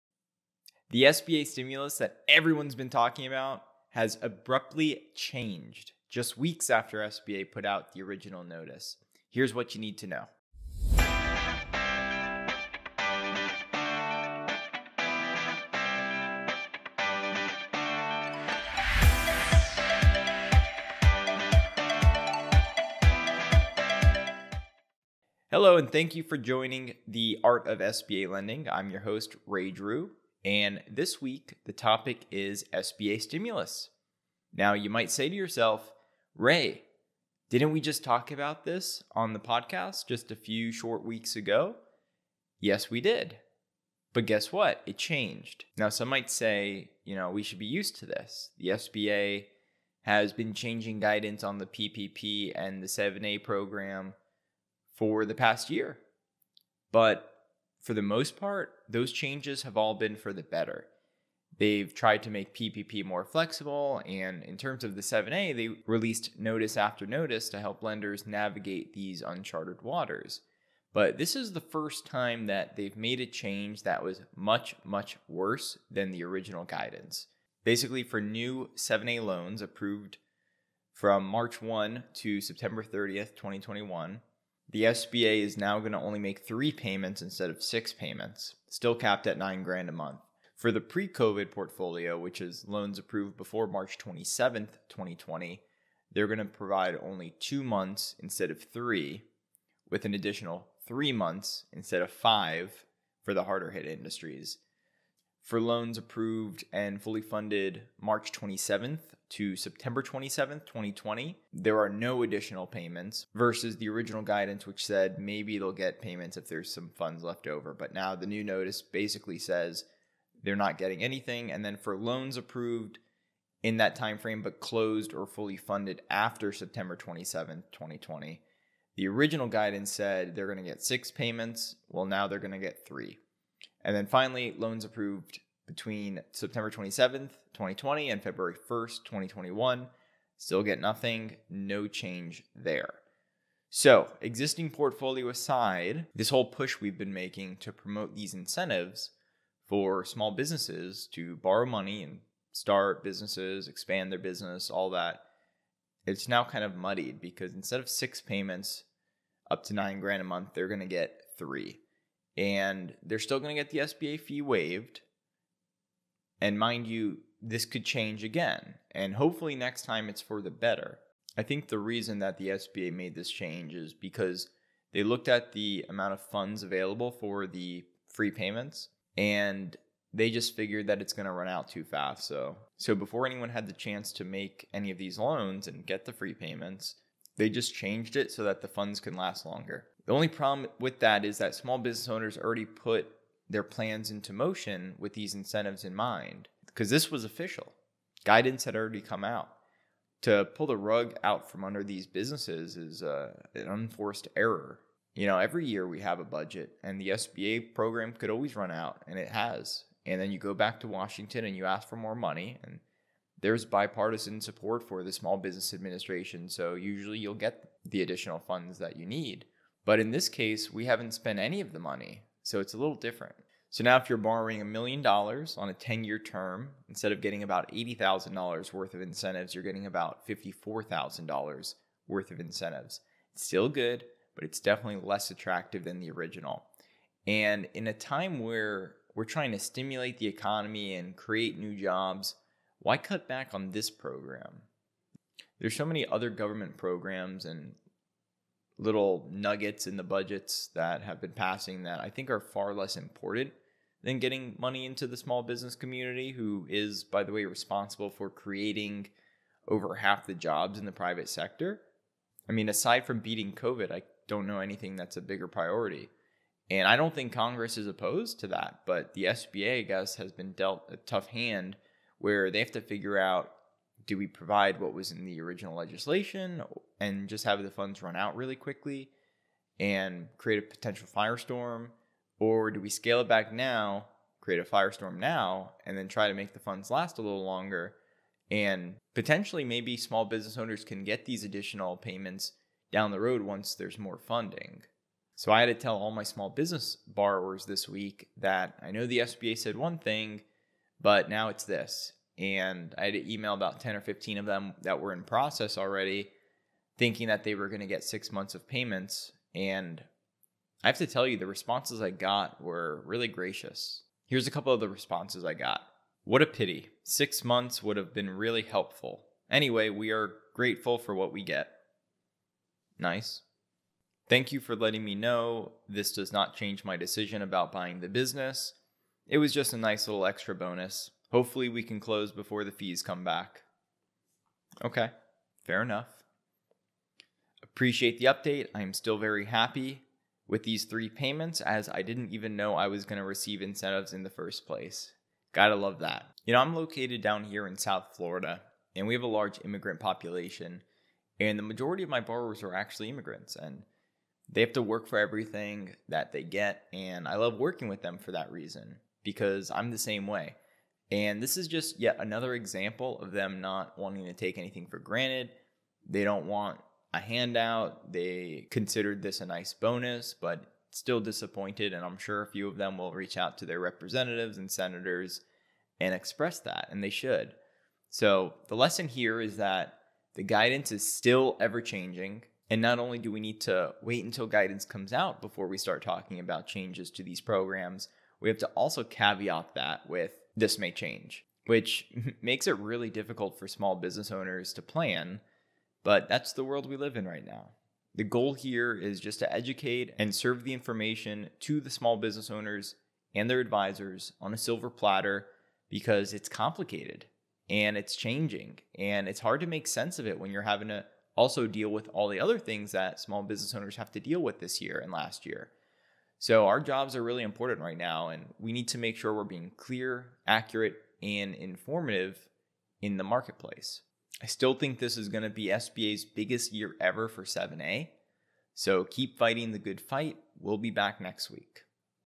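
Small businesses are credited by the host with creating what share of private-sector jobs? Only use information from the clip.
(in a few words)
over half.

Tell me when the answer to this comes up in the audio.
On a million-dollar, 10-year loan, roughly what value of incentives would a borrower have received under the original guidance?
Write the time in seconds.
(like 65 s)
227 s.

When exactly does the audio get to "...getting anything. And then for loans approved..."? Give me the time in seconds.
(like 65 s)
120 s.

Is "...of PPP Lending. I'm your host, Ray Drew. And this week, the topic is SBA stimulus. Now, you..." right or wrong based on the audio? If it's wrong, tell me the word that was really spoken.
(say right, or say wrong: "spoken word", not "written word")
wrong: "SBA", not "PPP".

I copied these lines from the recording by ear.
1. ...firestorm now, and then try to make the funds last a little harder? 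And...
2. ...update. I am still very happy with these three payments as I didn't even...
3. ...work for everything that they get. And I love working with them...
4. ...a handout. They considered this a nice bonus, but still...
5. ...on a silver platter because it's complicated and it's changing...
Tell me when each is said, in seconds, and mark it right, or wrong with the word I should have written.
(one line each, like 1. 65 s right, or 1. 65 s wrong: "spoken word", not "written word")
1. 284 s wrong: "longer", not "harder"
2. 338 s right
3. 354 s right
4. 367 s right
5. 404 s right.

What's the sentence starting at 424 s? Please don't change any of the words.
I still think this is going to be SBA's biggest year ever for 7A.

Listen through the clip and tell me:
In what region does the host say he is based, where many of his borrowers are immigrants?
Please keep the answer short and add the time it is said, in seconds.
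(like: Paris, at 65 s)
South Florida, at 347 s.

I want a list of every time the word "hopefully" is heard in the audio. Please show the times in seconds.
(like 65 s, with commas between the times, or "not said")
169 s, 331 s.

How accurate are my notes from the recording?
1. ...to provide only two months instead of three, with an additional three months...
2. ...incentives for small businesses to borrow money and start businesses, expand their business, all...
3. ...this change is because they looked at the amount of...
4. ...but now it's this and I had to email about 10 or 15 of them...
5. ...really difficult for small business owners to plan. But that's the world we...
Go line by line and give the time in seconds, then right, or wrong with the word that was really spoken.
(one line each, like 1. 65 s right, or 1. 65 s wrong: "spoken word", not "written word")
1. 96 s right
2. 148 s right
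3. 173 s right
4. 300 s right
5. 392 s right.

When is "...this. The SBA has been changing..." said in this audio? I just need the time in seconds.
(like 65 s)
48 s.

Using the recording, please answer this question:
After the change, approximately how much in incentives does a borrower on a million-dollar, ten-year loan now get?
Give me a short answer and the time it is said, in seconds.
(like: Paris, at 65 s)
$54,000, at 230 s.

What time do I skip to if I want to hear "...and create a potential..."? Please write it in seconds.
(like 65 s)
279 s.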